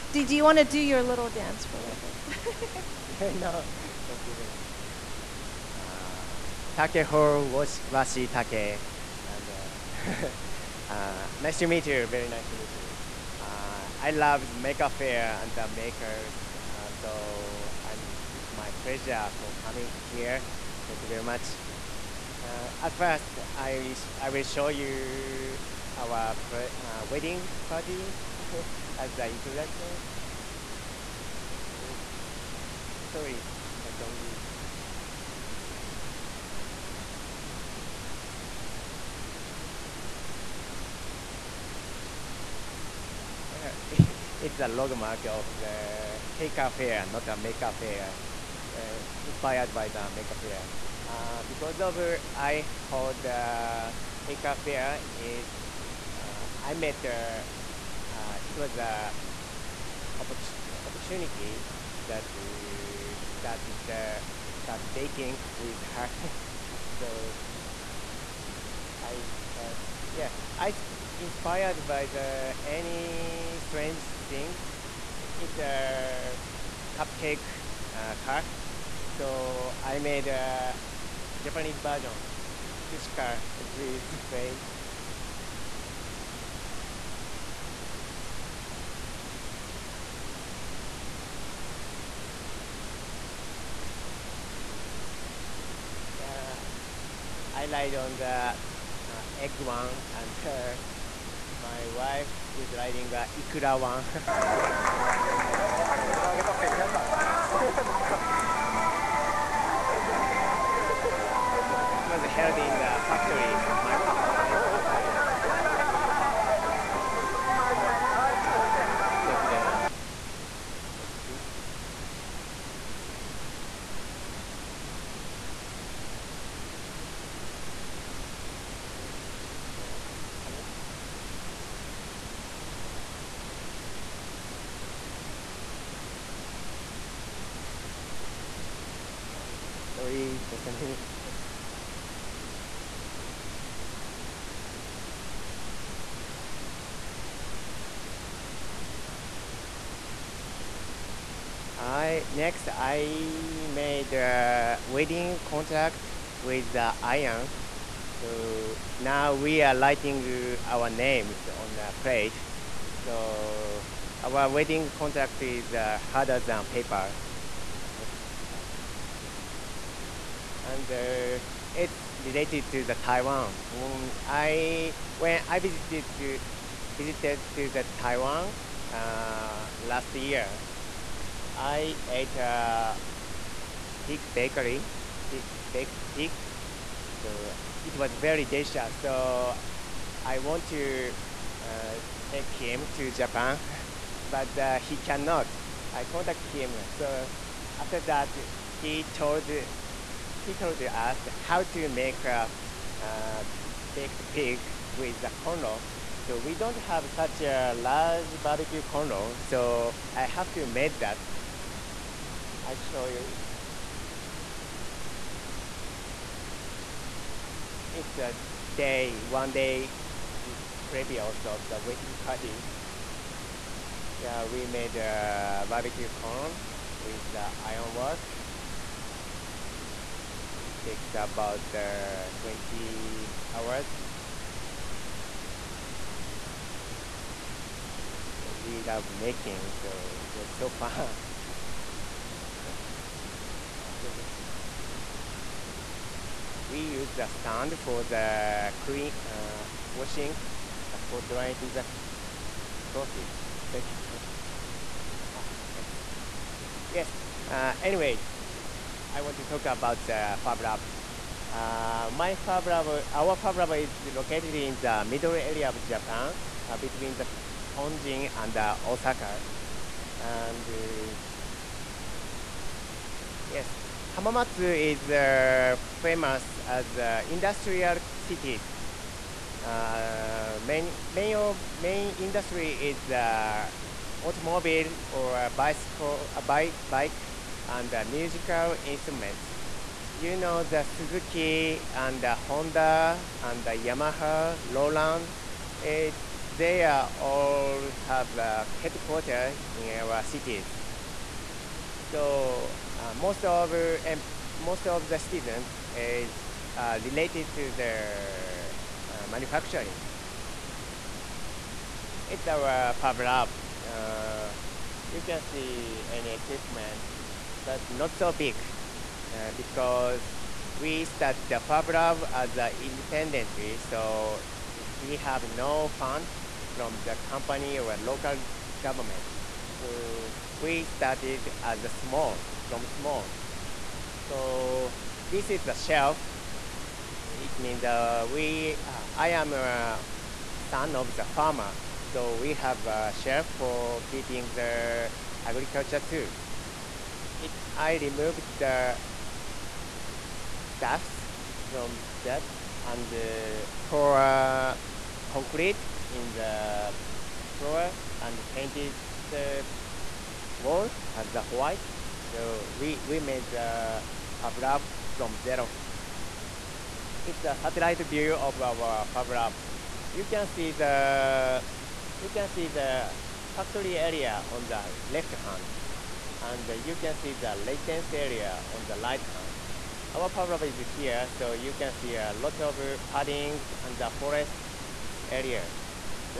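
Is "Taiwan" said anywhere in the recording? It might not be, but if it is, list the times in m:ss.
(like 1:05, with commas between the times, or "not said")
2:52, 2:57.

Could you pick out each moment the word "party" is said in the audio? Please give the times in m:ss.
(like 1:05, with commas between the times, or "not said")
0:27, 3:42.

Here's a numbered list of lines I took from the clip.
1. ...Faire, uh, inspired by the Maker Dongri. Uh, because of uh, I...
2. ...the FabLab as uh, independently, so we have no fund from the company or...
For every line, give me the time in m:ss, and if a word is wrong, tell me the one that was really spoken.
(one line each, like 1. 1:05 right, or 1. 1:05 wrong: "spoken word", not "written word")
1. 0:47 wrong: "Faire", not "Dongri"
2. 5:21 right.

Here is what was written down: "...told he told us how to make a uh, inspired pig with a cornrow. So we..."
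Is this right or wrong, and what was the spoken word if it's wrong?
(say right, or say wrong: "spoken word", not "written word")
wrong: "baked", not "inspired".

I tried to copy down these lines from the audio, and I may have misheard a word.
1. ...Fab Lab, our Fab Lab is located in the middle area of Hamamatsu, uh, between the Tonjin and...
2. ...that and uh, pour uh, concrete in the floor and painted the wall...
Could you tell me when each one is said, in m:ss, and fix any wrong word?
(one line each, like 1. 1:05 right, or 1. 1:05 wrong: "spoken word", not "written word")
1. 4:22 wrong: "Japan", not "Hamamatsu"
2. 5:52 right.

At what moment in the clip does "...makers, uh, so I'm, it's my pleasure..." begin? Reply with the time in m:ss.
0:15.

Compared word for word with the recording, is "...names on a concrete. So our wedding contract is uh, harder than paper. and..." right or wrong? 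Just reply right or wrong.
wrong.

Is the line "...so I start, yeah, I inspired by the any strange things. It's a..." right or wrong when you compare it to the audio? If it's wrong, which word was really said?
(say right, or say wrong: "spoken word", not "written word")
right.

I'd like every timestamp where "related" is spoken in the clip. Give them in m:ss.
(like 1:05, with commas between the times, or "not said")
2:52, 5:07.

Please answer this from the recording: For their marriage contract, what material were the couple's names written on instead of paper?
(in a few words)
Iron.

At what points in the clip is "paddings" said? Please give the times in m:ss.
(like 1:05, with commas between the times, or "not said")
6:23.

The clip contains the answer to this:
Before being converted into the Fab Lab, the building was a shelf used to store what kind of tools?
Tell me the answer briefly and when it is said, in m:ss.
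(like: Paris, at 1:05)
Agriculture tools, at 5:45.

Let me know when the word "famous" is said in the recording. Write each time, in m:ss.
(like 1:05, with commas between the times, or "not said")
4:35.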